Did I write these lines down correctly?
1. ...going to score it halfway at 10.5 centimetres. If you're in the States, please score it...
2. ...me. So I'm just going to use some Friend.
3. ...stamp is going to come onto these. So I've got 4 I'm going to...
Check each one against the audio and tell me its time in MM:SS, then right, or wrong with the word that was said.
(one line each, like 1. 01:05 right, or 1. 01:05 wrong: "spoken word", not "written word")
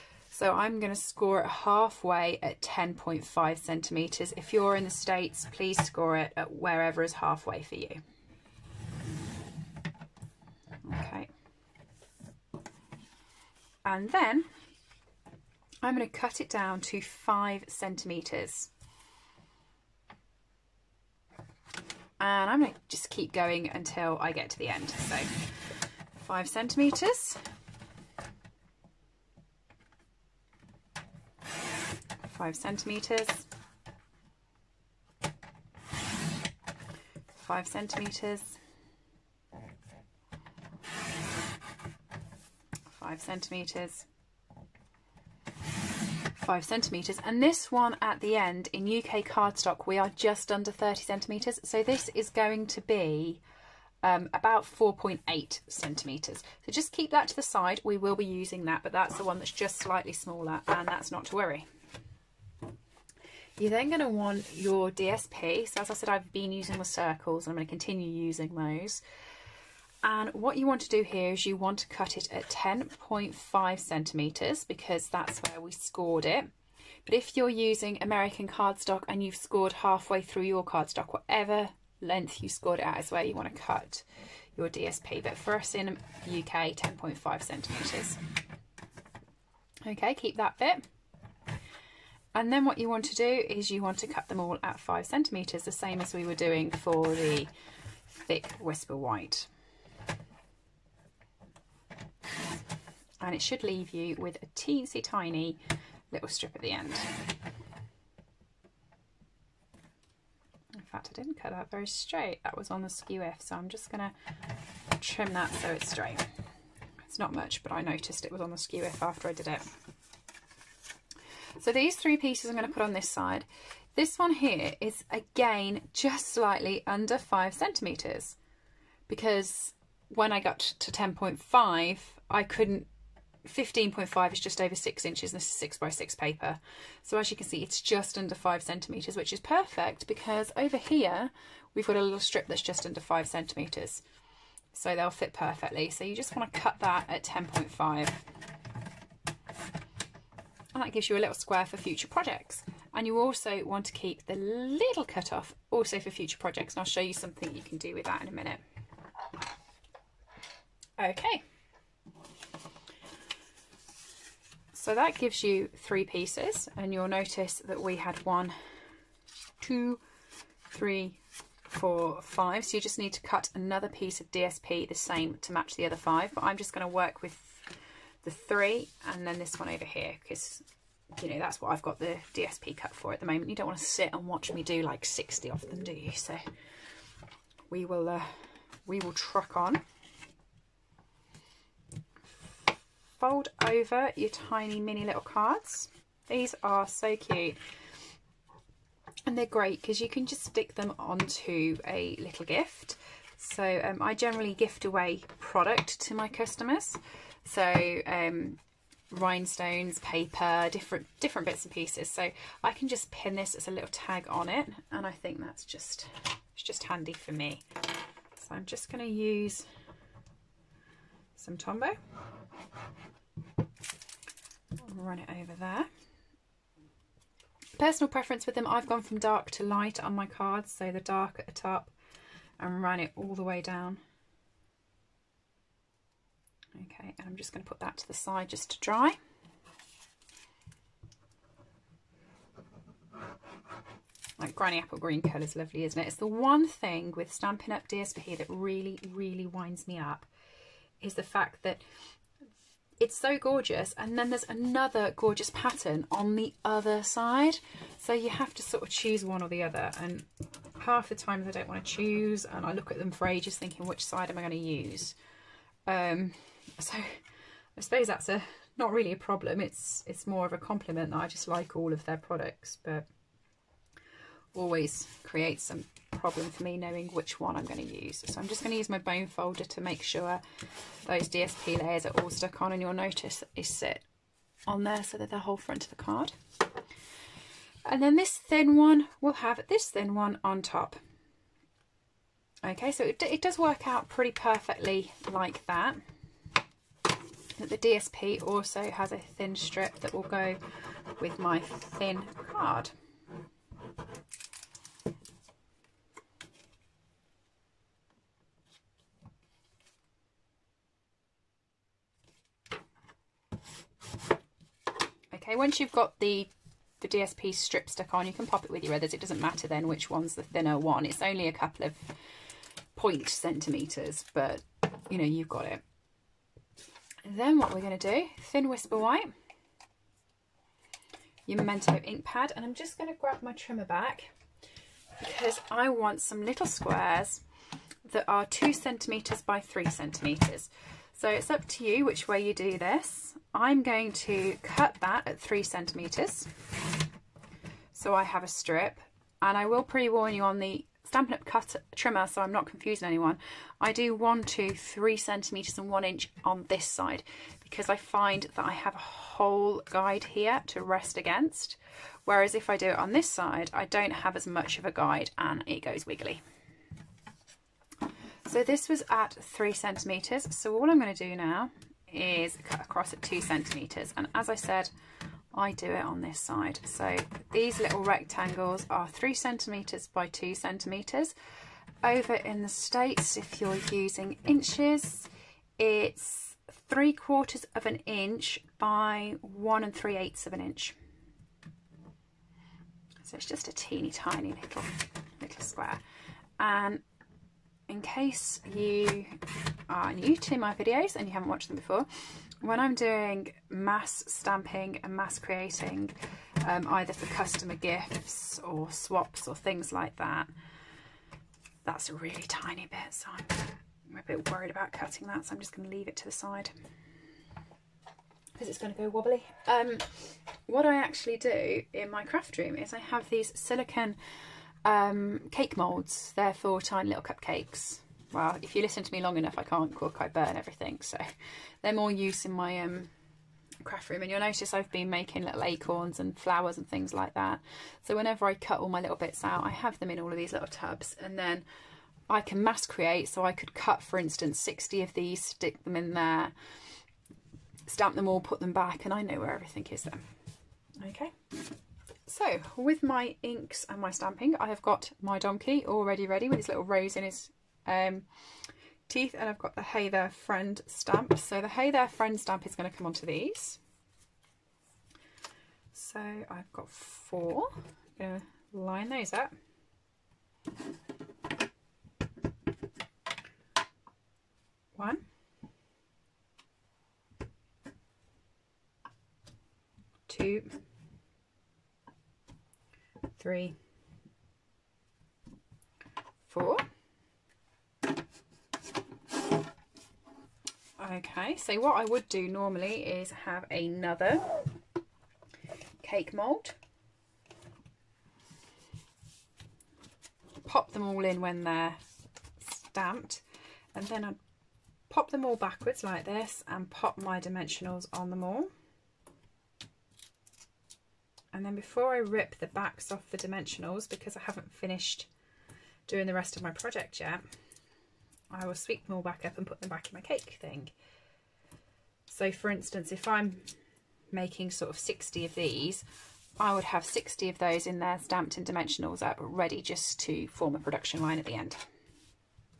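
1. 00:00 right
2. 03:37 wrong: "Tombow", not "Friend"
3. 07:42 right.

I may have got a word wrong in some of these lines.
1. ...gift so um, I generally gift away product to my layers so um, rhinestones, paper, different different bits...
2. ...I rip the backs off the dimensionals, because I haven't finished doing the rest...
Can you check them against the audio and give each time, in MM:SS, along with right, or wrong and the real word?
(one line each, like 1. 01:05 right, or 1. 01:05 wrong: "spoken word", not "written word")
1. 03:22 wrong: "customers", not "layers"
2. 08:32 right.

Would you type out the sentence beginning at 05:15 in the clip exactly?
Okay, once you've got the the DSP strip stuck on, you can pop it with your others.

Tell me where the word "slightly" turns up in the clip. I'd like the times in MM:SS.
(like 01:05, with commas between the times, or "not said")
00:59, 02:06.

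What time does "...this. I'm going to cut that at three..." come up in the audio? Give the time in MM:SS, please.
05:42.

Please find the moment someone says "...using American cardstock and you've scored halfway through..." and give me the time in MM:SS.
01:17.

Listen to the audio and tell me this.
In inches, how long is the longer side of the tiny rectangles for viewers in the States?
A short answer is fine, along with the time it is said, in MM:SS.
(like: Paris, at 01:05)
1 and 3/8 inch, at 06:29.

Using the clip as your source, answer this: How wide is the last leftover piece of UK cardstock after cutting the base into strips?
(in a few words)
4.8 centimetres.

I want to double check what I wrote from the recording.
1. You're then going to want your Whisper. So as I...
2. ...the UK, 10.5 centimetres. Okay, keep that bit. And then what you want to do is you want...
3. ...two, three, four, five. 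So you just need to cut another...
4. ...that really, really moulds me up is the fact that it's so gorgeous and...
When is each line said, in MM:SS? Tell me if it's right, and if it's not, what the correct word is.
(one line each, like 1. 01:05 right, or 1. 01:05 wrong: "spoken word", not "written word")
1. 01:03 wrong: "DSP", not "Whisper"
2. 01:26 right
3. 02:49 right
4. 04:08 wrong: "winds", not "moulds".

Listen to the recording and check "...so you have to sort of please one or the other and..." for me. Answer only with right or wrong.
wrong.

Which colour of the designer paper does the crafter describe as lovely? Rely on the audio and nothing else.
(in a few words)
granny apple green.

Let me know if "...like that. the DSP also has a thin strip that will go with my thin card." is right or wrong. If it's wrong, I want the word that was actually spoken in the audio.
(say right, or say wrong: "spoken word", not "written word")
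right.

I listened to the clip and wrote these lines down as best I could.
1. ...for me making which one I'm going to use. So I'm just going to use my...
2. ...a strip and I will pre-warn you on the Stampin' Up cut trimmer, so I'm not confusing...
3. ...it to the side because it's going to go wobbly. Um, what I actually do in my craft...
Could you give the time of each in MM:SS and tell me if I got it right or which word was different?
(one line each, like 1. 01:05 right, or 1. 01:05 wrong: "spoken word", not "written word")
1. 04:36 wrong: "knowing", not "making"
2. 05:48 right
3. 06:56 right.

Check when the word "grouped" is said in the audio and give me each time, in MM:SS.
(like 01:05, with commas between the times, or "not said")
not said.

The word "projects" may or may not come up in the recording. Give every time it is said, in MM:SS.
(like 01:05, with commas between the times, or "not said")
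02:32, 02:36, 08:36.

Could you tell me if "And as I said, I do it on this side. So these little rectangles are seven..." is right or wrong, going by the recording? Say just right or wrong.
wrong.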